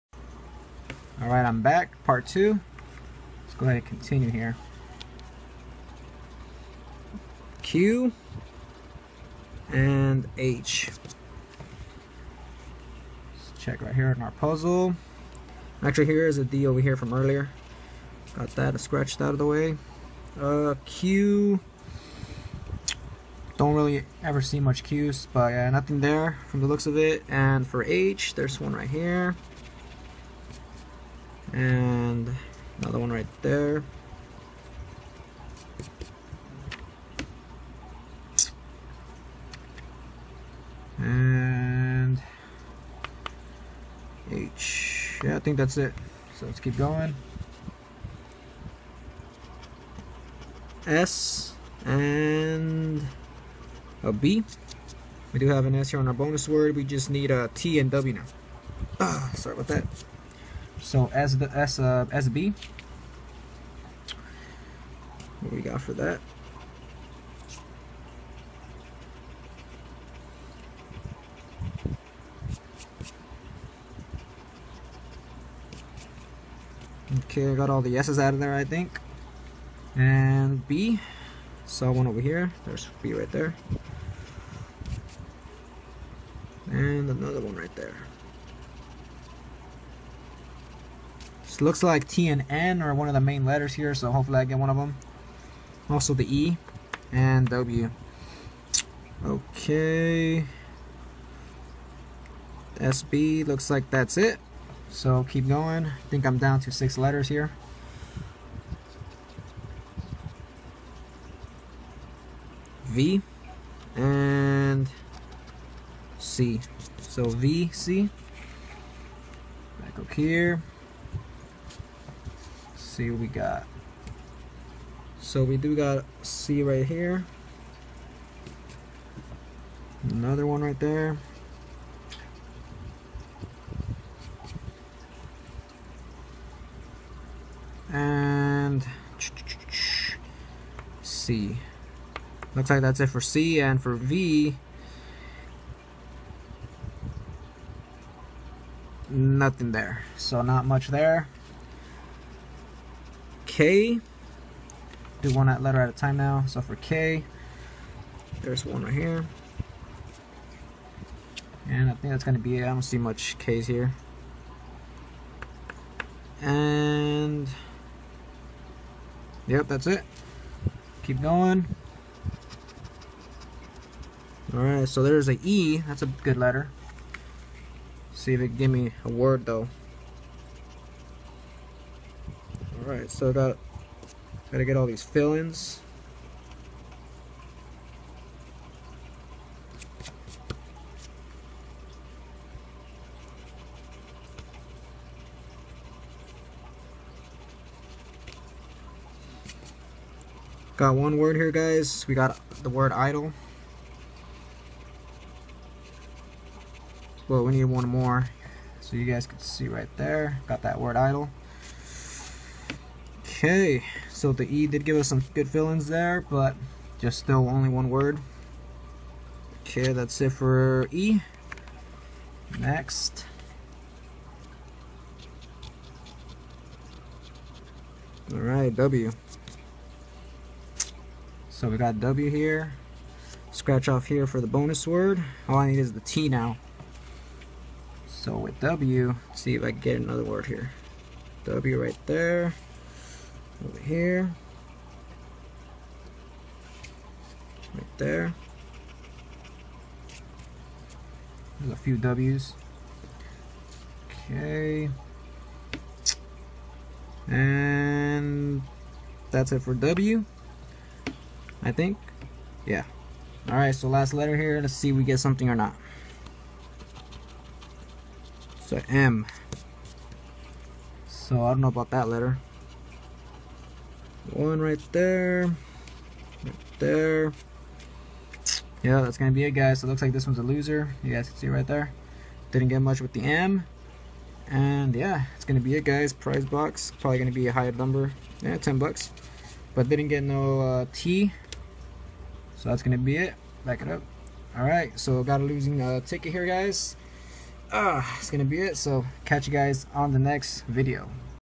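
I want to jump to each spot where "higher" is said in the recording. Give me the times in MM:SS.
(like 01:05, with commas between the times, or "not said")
04:47.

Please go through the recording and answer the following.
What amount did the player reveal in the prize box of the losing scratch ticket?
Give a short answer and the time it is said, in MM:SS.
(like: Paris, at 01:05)
$10, at 04:48.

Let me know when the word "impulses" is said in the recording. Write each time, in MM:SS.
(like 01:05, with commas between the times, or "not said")
not said.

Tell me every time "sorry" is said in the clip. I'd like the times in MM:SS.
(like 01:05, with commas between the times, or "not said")
00:59.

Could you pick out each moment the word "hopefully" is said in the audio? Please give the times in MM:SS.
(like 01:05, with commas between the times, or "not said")
01:34.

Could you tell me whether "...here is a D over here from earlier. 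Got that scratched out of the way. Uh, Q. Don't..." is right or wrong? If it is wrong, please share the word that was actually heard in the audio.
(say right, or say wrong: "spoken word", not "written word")
right.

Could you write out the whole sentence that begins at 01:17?
Okay, I got all the S's out of there, I think.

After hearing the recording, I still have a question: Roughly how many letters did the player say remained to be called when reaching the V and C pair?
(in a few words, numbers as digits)
6.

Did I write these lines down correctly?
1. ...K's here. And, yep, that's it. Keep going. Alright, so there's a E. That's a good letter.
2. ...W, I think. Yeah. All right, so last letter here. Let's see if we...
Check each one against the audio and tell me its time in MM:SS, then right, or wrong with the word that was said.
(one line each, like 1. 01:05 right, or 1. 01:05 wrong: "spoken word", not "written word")
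1. 02:43 right
2. 04:19 right.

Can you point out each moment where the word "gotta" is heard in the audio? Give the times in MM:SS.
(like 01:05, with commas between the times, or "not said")
03:04.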